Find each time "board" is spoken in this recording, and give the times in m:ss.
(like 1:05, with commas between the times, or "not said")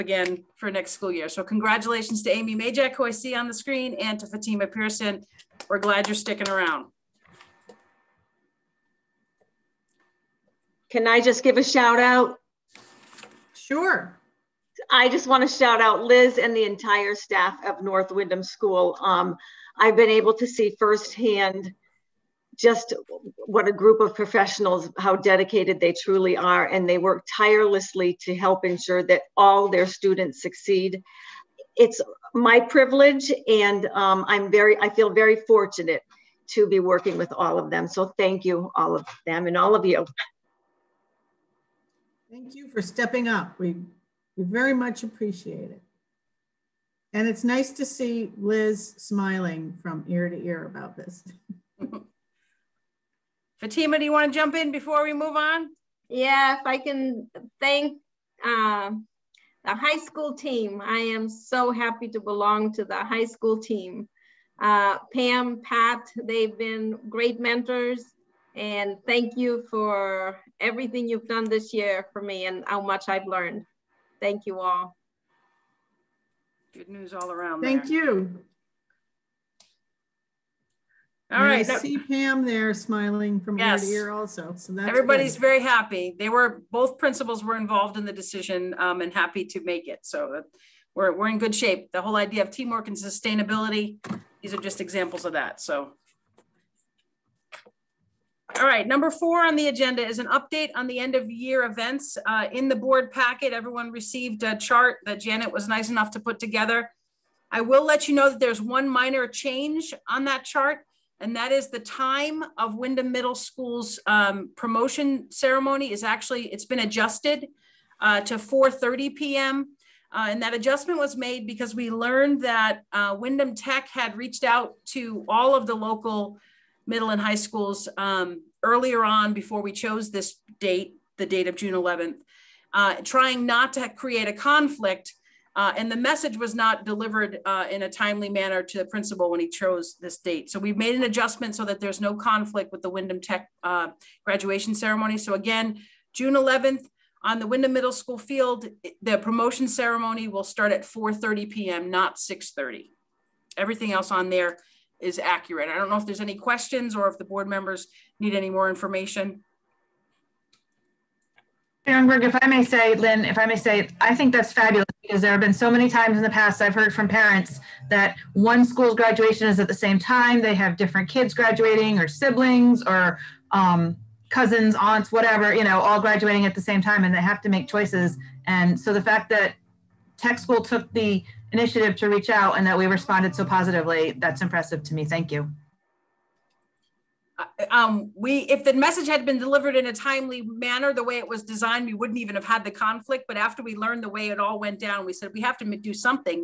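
1:42, 2:37.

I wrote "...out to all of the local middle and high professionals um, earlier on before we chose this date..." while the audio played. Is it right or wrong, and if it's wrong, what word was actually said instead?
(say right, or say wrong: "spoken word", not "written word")
wrong: "schools", not "professionals".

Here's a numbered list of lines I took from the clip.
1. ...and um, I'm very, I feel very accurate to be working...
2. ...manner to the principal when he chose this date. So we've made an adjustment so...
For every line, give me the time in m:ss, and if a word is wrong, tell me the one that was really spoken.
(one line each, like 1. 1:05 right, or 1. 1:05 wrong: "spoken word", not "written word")
1. 0:33 wrong: "fortunate", not "accurate"
2. 2:18 right.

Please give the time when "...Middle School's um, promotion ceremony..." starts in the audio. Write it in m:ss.
1:53.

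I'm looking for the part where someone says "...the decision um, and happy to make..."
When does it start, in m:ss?
1:28.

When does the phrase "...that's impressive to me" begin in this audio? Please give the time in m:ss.
3:04.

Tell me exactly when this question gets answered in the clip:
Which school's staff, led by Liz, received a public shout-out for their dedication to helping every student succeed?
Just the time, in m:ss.
0:17.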